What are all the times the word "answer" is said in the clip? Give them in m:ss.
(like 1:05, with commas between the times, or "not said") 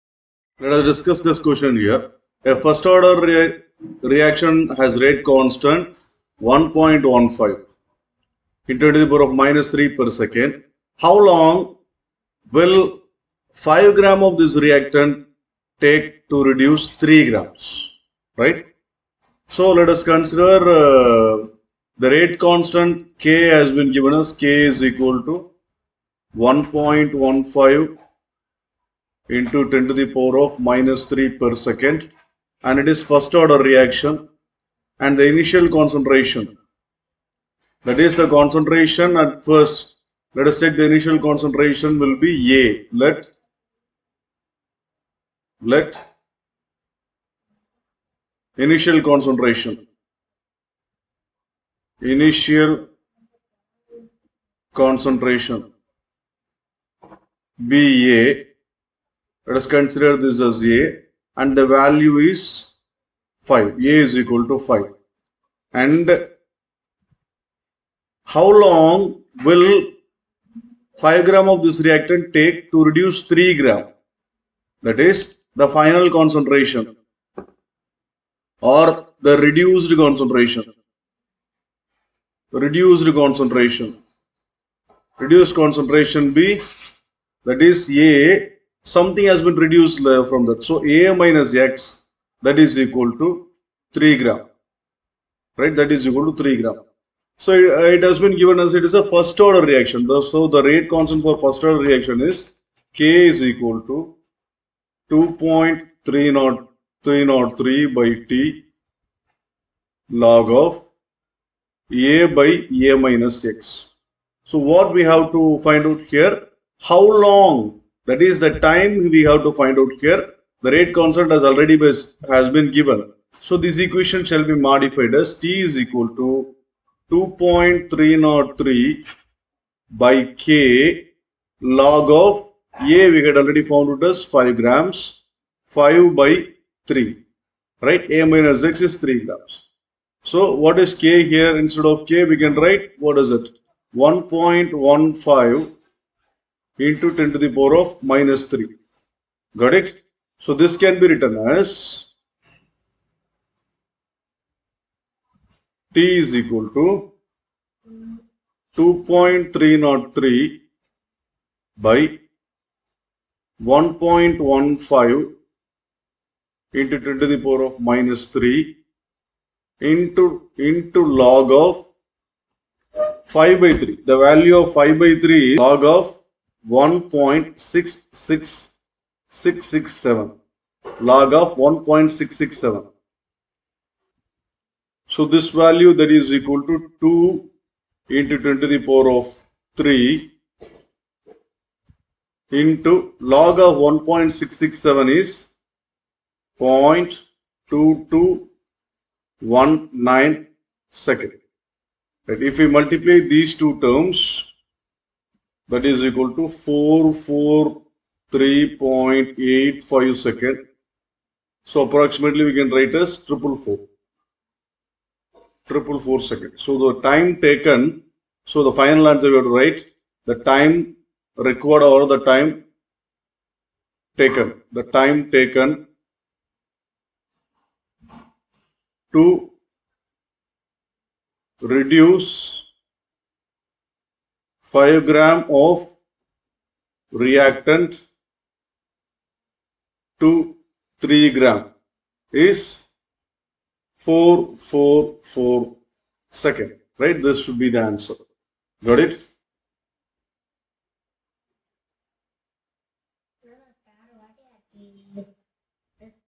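3:39, 4:07.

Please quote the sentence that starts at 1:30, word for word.
So A minus X that is equal to 3 gram, right?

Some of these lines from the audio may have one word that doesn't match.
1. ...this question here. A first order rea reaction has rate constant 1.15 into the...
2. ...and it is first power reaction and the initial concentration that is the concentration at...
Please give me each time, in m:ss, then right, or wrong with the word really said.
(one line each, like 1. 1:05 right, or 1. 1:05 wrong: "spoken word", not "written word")
1. 0:01 right
2. 0:32 wrong: "order", not "power".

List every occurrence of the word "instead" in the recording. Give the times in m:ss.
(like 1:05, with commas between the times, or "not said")
2:21.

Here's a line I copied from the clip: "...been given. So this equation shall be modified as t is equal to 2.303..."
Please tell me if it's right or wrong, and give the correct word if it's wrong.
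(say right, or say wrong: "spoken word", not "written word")
right.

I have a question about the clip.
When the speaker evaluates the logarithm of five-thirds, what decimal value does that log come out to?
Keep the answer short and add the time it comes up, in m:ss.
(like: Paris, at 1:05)
0.2219, at 3:16.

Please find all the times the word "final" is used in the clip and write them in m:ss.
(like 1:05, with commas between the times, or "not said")
1:15, 3:38.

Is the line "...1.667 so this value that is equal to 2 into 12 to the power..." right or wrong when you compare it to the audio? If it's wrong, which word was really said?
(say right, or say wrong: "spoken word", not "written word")
wrong: "10", not "12".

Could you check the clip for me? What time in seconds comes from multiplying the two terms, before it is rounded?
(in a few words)
443.85 seconds.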